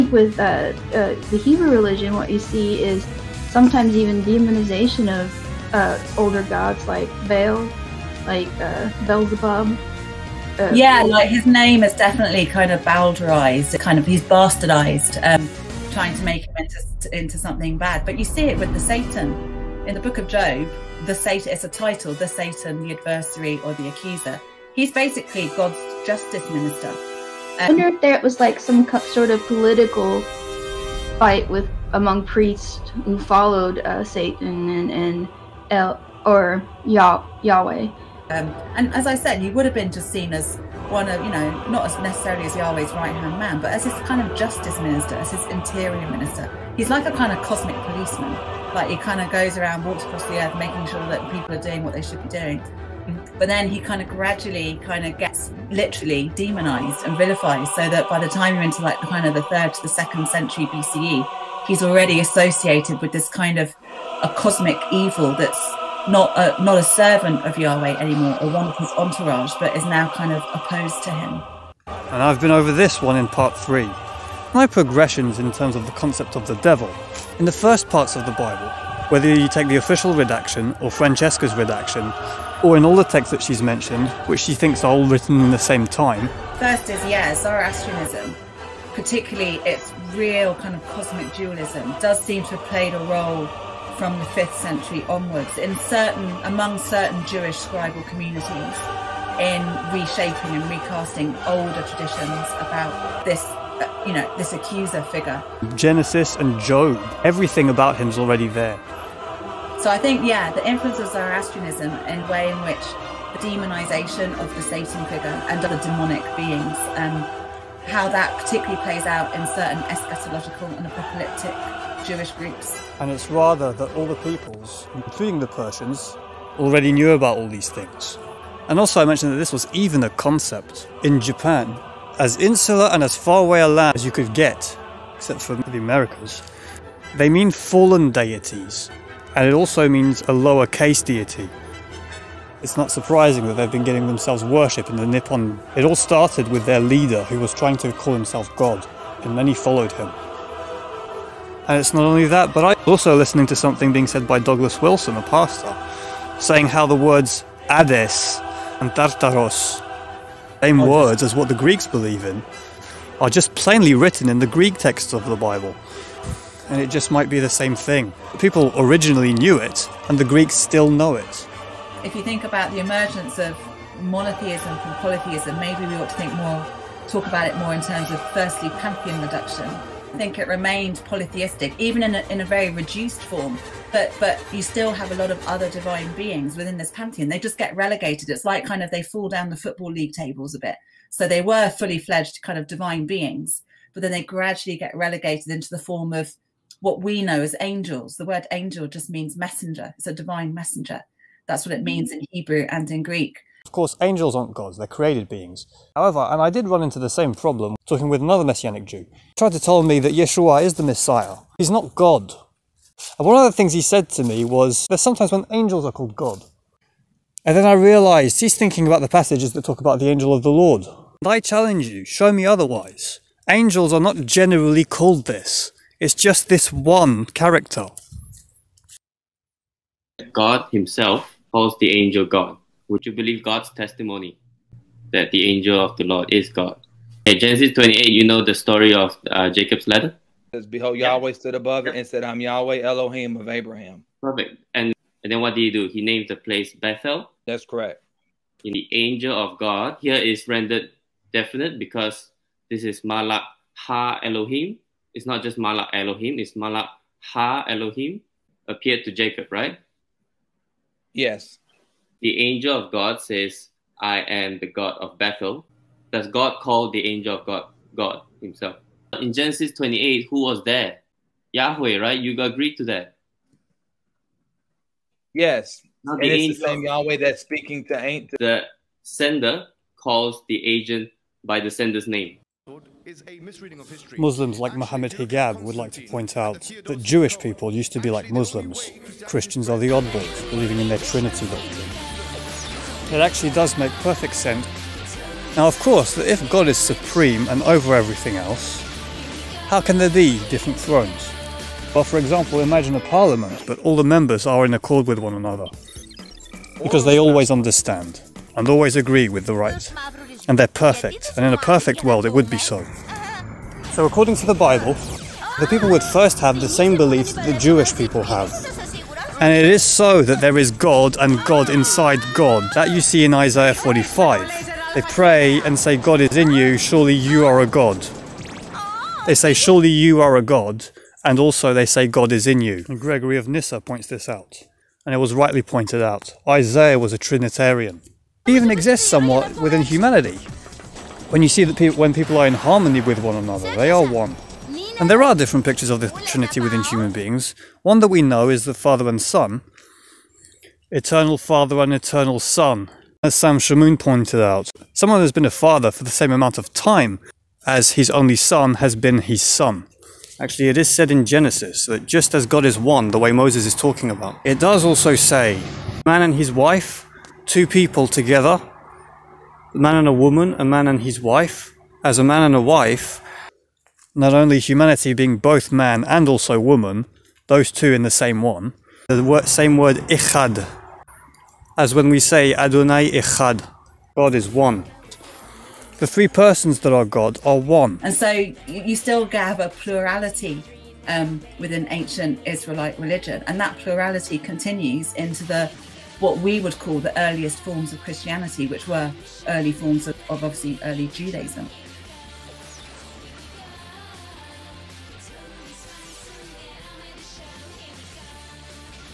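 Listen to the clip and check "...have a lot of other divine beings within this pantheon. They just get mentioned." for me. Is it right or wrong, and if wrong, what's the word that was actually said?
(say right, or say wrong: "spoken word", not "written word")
wrong: "relegated", not "mentioned".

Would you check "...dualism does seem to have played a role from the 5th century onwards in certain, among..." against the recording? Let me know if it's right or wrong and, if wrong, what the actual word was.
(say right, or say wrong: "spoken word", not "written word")
right.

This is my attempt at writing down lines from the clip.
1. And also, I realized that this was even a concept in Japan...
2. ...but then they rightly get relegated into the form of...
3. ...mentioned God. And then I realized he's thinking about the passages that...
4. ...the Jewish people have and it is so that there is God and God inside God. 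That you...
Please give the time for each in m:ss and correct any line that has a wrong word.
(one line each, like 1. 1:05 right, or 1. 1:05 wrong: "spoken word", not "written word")
1. 2:08 wrong: "mentioned", not "realized"
2. 3:13 wrong: "gradually", not "rightly"
3. 3:35 wrong: "called", not "mentioned"
4. 5:17 right.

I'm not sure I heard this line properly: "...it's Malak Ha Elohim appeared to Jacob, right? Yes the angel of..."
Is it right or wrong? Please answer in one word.
right.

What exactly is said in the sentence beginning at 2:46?
And it just might be the same thing.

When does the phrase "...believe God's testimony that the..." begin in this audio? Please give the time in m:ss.
3:53.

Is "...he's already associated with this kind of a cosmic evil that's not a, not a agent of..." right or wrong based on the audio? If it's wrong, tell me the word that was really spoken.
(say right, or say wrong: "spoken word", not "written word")
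wrong: "servant", not "agent".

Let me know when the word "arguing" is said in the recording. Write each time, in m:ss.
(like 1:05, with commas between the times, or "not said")
not said.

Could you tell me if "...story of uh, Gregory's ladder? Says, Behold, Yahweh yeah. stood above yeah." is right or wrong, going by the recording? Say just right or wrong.
wrong.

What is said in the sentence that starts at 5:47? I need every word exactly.
One that we know is the Father and Son, Eternal Father and Eternal Son, as Sam Shamoun pointed out.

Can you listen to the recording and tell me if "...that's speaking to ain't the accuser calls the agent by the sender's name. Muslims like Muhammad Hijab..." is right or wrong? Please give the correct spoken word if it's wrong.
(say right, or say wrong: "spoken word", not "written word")
wrong: "sender", not "accuser".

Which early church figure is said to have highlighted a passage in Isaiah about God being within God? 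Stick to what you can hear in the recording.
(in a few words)
Gregory of Nyssa.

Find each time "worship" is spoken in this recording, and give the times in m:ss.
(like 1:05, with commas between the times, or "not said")
2:24.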